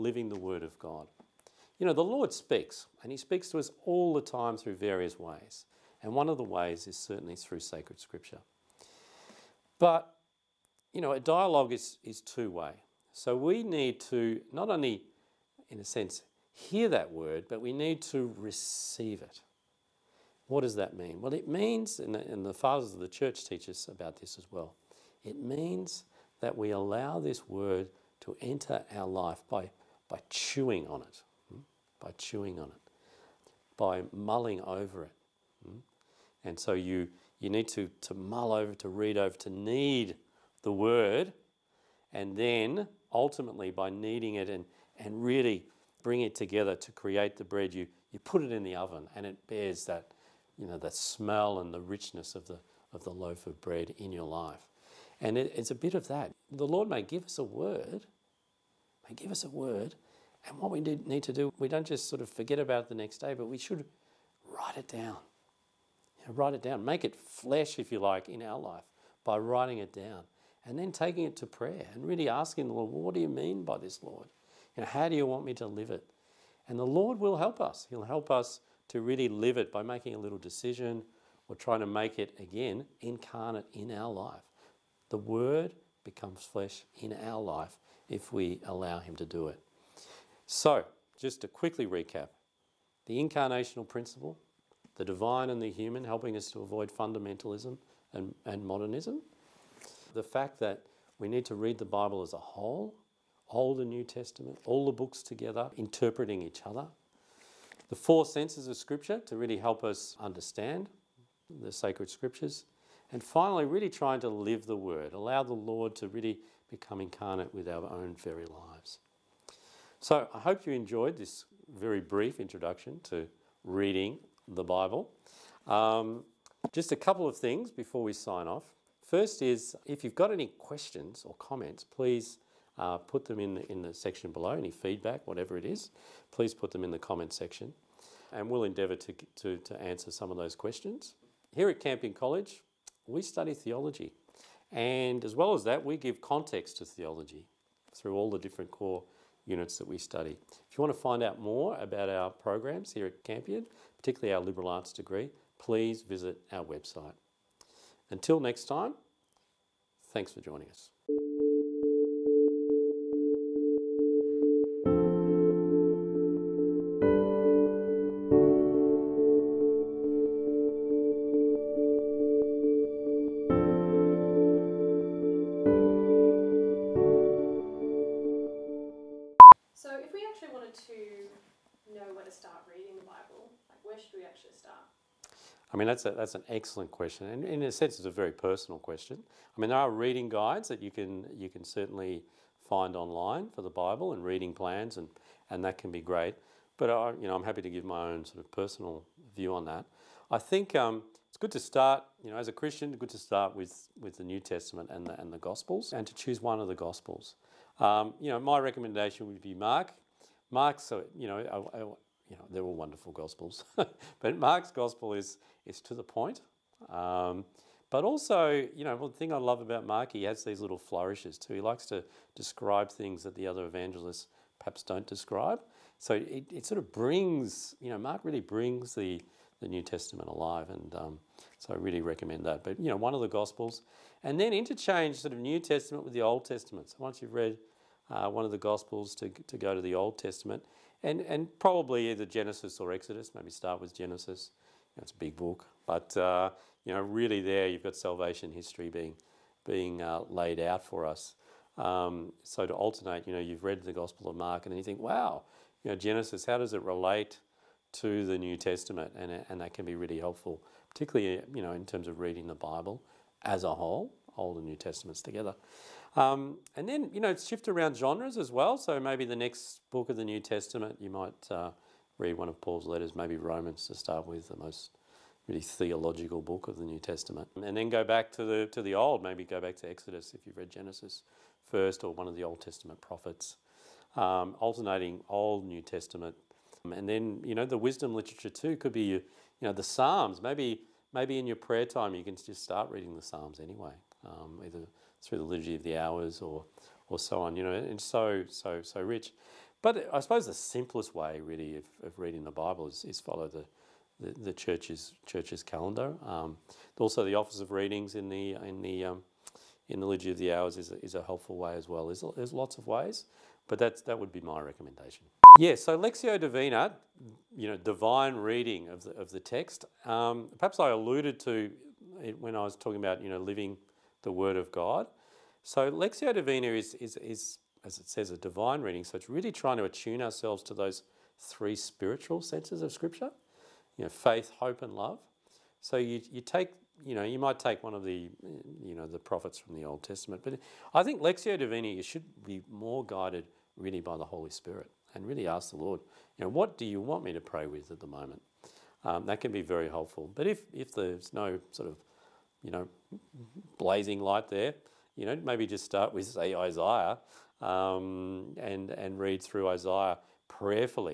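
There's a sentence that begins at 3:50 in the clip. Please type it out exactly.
And um, so I really recommend that.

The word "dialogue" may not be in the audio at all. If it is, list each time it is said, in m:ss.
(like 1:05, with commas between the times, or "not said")
0:11.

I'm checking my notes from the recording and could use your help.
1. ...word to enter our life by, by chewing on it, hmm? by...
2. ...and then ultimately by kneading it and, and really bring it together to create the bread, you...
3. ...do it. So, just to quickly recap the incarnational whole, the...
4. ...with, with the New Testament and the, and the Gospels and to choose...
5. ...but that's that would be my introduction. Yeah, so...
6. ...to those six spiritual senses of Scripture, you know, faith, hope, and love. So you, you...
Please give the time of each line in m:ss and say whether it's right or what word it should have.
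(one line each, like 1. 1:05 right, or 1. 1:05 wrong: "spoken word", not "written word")
1. 0:27 right
2. 0:42 right
3. 1:29 wrong: "principle", not "whole"
4. 3:23 right
5. 5:13 wrong: "recommendation", not "introduction"
6. 5:30 wrong: "three", not "six".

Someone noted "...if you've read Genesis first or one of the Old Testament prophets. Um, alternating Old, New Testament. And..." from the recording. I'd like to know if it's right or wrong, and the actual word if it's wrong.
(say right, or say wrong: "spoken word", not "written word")
right.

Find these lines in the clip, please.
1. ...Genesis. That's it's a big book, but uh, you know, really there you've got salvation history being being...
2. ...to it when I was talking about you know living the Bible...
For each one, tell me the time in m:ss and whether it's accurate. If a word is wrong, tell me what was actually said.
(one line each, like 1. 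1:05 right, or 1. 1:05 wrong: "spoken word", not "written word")
1. 4:03 right
2. 5:21 wrong: "Word", not "Bible".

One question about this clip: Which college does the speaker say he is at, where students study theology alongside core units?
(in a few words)
Campion College.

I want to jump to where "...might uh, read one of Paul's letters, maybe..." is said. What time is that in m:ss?
4:31.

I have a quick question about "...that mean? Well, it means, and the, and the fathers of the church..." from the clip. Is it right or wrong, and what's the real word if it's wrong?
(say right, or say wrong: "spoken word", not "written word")
right.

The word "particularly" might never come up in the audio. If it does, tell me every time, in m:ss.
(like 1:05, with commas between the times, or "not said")
2:34, 4:20.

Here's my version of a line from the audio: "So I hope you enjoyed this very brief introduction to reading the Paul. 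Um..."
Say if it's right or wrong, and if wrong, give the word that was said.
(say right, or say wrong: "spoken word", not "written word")
wrong: "Bible", not "Paul".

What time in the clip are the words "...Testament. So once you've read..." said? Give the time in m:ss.
3:56.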